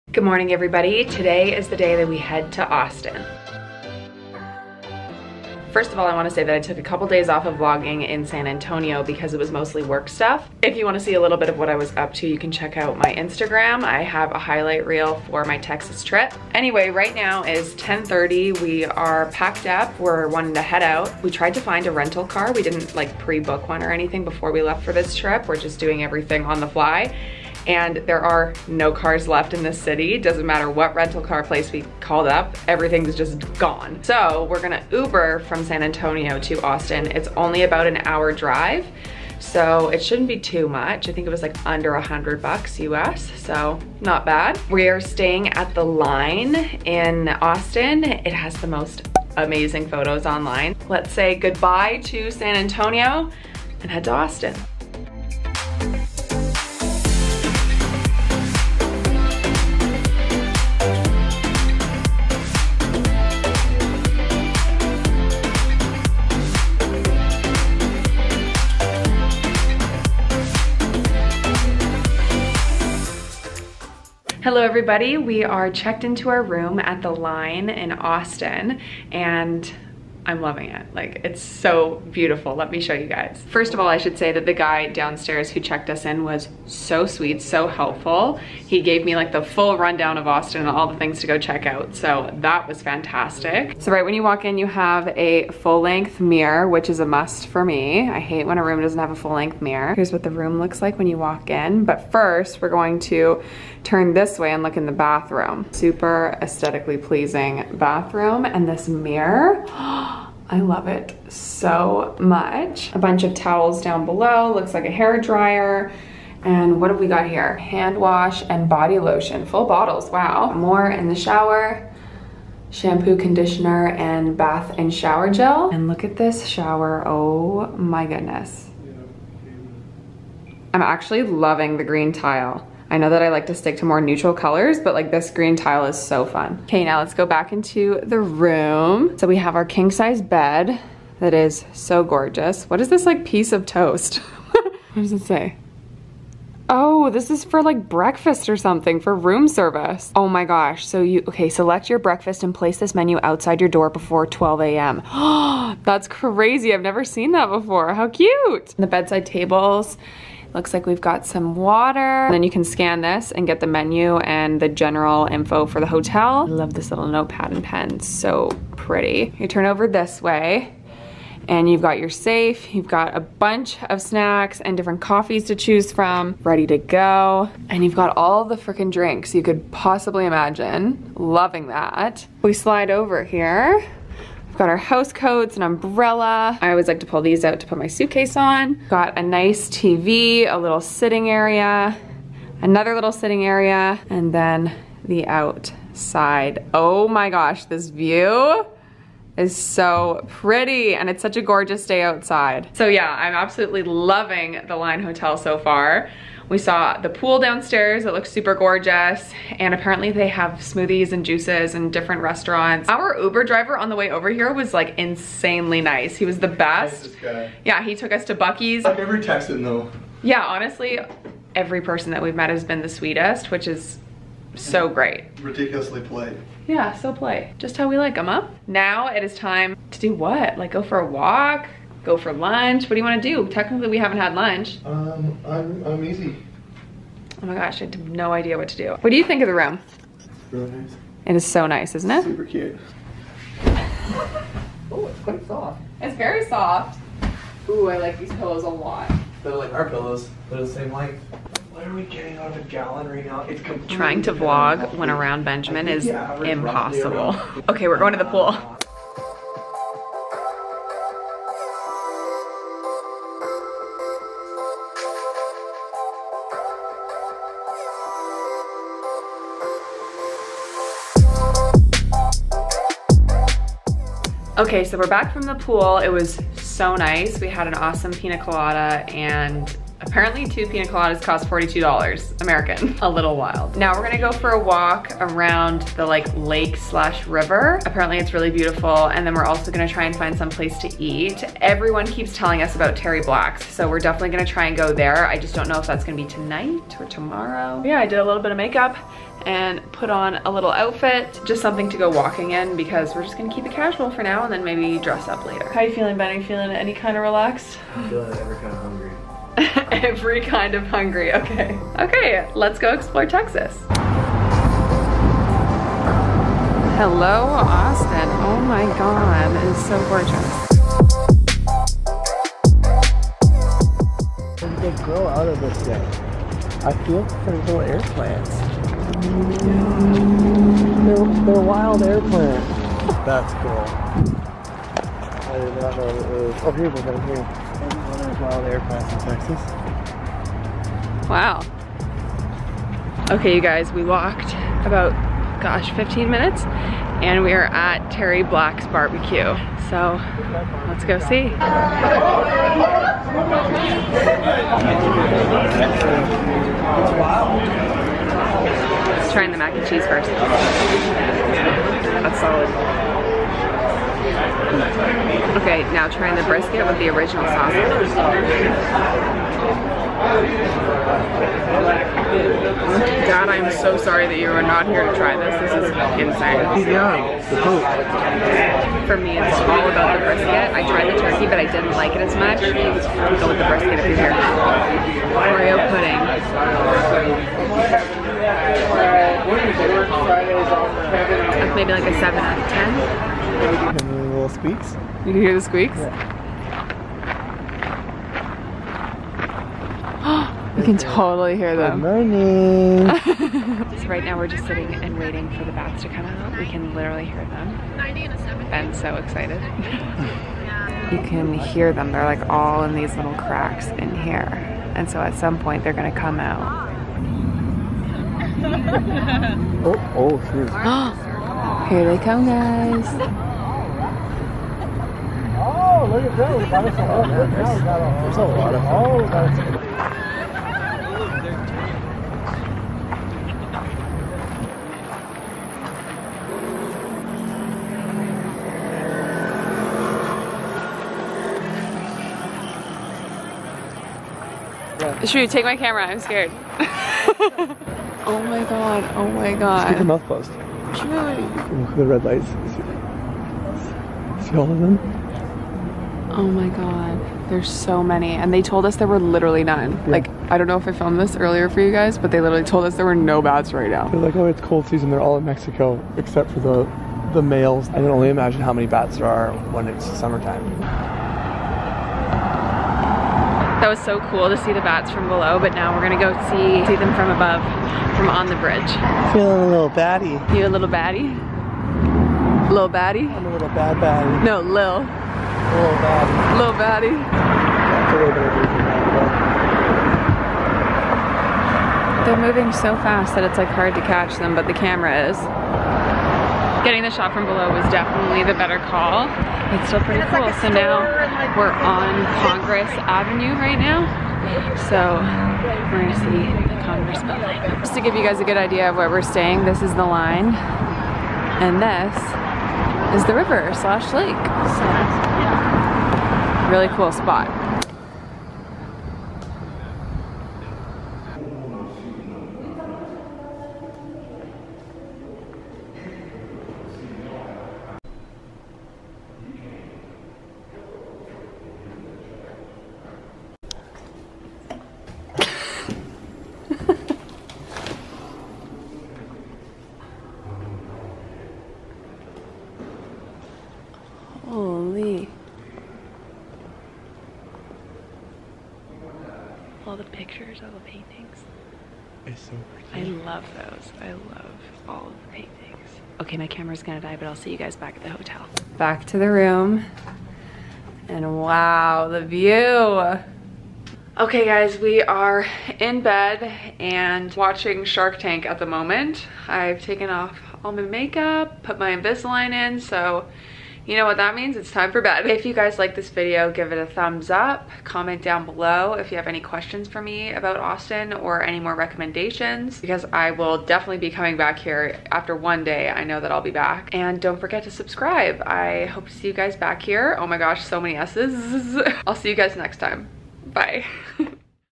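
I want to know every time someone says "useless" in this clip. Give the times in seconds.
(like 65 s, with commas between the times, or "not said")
not said.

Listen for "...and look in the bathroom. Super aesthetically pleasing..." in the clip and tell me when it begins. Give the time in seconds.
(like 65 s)
104 s.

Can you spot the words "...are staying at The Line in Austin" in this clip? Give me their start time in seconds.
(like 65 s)
44 s.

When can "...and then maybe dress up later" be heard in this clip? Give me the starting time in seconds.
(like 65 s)
304 s.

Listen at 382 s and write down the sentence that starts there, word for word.
Go with the brisket if you're here.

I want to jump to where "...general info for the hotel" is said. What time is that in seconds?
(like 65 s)
164 s.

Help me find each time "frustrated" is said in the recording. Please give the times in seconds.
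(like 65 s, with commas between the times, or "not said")
not said.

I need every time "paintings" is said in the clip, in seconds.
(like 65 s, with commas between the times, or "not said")
550 s, 555 s.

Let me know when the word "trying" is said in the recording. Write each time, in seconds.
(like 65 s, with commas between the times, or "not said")
253 s, 359 s, 366 s.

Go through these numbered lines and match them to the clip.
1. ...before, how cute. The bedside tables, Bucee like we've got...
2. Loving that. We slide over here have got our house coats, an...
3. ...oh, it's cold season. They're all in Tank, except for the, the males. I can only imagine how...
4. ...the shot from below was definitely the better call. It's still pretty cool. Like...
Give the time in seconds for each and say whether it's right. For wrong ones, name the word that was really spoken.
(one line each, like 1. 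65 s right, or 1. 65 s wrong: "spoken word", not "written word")
1. 157 s wrong: "Looks", not "Bucee"
2. 181 s right
3. 464 s wrong: "Mexico", not "Tank"
4. 497 s right.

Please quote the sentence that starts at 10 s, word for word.
If you wanna see a little bit of what I was up to, you can check out my Instagram.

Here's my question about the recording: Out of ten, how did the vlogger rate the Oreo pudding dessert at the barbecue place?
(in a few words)
7.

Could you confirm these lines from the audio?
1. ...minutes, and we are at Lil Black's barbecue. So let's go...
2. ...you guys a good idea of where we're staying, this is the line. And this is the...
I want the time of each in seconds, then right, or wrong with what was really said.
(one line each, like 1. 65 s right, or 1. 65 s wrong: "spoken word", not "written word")
1. 346 s wrong: "Terry", not "Lil"
2. 508 s right.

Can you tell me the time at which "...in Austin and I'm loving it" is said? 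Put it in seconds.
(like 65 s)
77 s.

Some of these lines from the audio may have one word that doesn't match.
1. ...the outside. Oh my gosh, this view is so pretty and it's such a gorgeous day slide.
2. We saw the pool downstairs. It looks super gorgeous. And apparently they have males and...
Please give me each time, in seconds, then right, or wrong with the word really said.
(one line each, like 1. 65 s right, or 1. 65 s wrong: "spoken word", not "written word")
1. 195 s wrong: "outside", not "slide"
2. 206 s wrong: "smoothies", not "males".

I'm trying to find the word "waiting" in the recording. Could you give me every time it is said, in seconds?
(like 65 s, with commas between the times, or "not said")
405 s.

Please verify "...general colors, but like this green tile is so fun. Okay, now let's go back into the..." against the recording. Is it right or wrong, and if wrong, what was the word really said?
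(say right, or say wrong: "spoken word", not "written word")
wrong: "neutral", not "general".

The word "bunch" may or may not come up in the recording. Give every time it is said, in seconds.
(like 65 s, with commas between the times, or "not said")
112 s, 173 s.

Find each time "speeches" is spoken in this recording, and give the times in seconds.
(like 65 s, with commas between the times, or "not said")
not said.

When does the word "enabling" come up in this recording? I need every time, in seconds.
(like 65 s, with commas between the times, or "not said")
not said.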